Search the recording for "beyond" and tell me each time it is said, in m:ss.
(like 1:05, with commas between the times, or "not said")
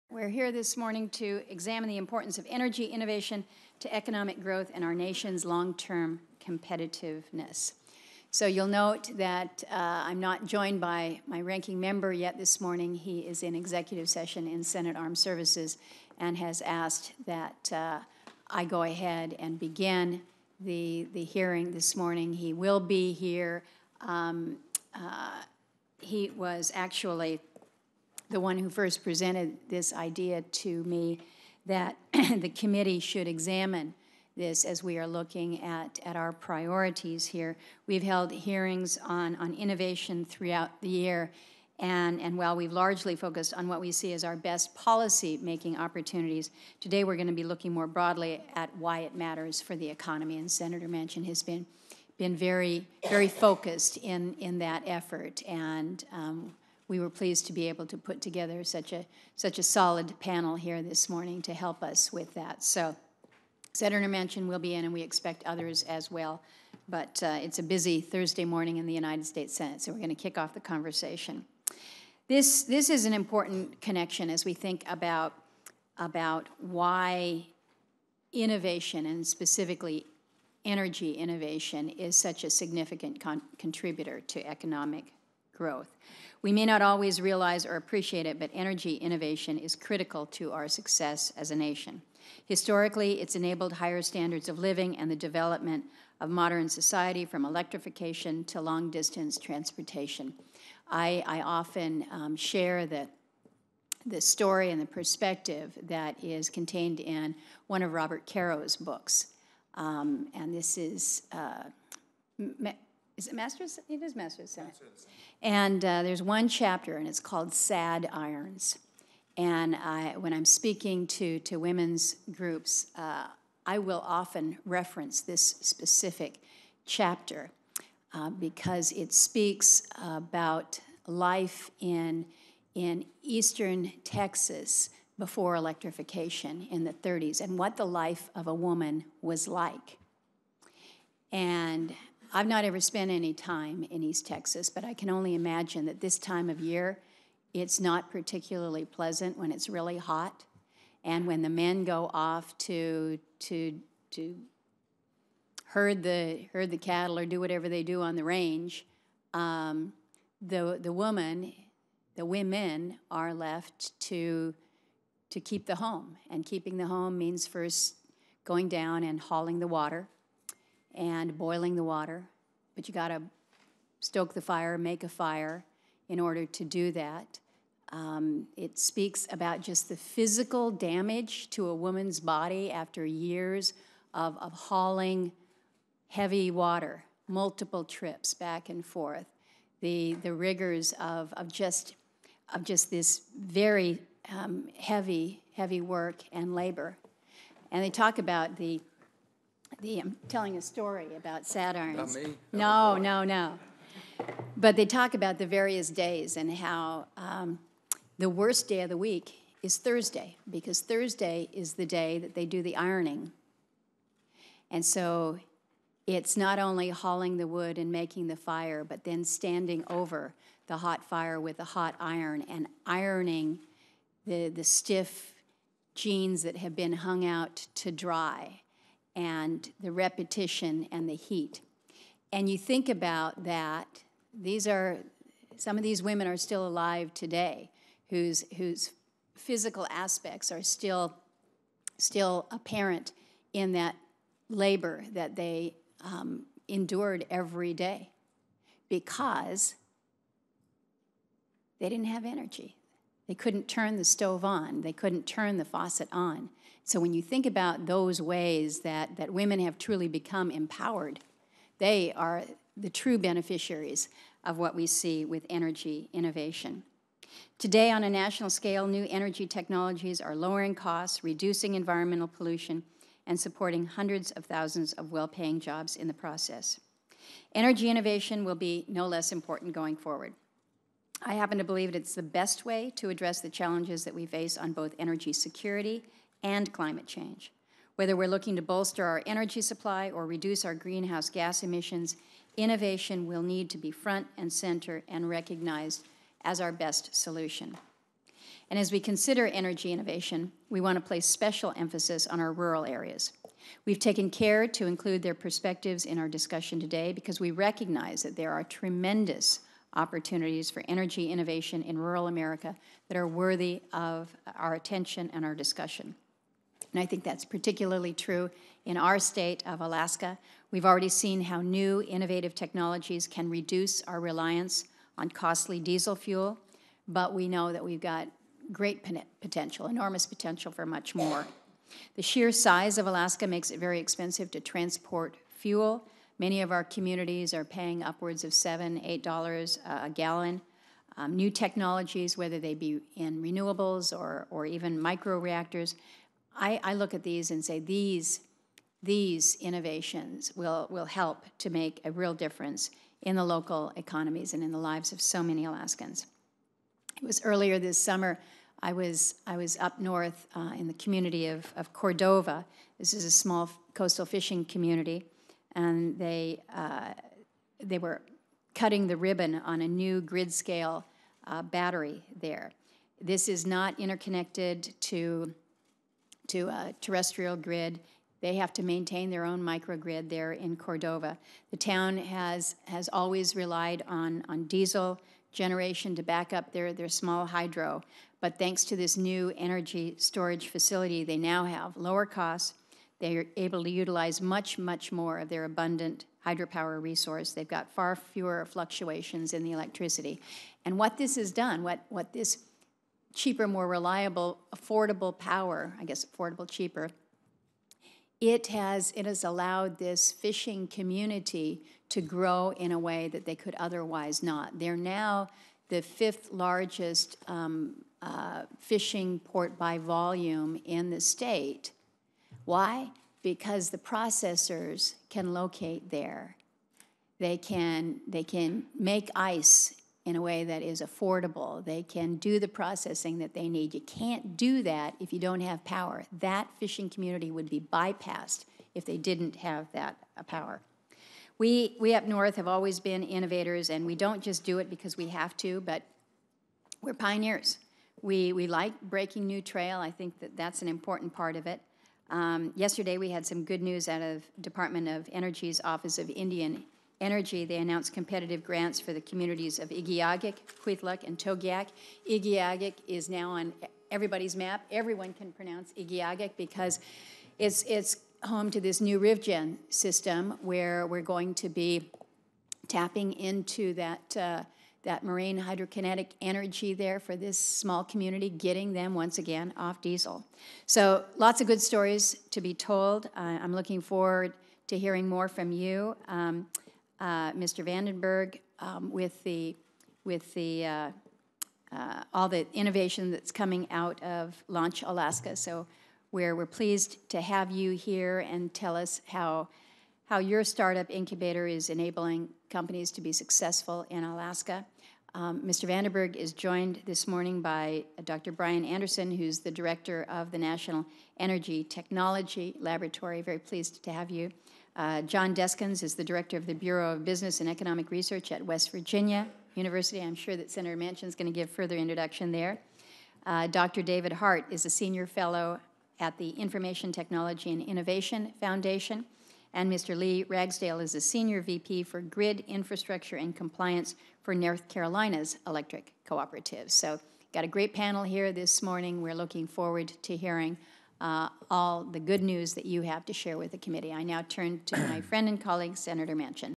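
not said.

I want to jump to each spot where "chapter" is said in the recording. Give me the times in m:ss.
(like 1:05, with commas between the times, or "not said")
1:56, 2:06.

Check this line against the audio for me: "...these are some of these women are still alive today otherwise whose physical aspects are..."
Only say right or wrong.
wrong.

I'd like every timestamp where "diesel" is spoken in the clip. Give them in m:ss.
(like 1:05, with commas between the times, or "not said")
5:25, 6:24, 8:00.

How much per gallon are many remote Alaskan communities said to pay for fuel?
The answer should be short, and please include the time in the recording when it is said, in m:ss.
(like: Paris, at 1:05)
$7-8, at 5:38.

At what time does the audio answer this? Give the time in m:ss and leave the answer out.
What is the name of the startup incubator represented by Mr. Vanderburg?
8:14.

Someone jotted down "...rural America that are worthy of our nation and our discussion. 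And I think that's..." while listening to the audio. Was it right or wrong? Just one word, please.
wrong.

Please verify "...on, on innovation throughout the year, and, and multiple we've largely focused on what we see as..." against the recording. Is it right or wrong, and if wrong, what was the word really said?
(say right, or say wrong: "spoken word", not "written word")
wrong: "while", not "multiple".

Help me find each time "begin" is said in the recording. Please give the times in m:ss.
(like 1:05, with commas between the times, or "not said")
0:19.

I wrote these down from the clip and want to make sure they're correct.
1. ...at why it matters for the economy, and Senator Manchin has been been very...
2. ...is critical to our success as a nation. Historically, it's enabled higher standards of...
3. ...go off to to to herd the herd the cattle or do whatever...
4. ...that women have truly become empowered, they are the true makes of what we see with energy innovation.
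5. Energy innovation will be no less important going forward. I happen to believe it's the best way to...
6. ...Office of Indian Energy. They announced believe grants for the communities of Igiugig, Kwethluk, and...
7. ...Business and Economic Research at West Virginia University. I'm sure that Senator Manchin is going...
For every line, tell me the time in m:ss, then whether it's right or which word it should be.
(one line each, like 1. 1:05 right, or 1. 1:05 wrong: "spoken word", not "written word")
1. 0:48 right
2. 1:29 right
3. 2:31 right
4. 4:19 wrong: "beneficiaries", not "makes"
5. 4:37 right
6. 7:35 wrong: "competitive", not "believe"
7. 8:37 right.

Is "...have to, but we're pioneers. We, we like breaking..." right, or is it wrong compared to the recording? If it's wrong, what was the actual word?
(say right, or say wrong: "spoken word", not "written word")
right.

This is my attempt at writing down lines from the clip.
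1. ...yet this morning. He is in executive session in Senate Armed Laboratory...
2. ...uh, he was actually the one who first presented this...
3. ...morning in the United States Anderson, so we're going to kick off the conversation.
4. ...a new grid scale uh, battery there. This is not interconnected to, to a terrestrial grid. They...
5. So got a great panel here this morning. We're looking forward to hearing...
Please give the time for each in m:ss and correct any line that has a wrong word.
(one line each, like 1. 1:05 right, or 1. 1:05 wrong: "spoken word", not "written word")
1. 0:12 wrong: "Services", not "Laboratory"
2. 0:24 right
3. 1:08 wrong: "Senate", not "Anderson"
4. 6:09 right
5. 8:56 right.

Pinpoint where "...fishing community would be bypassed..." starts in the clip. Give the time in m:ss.
7:16.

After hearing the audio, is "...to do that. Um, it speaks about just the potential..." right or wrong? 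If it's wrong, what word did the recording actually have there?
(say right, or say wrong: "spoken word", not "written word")
wrong: "physical", not "potential".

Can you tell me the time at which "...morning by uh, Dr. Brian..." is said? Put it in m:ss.
8:27.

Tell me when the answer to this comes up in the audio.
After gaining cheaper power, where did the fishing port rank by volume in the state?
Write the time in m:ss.
6:56.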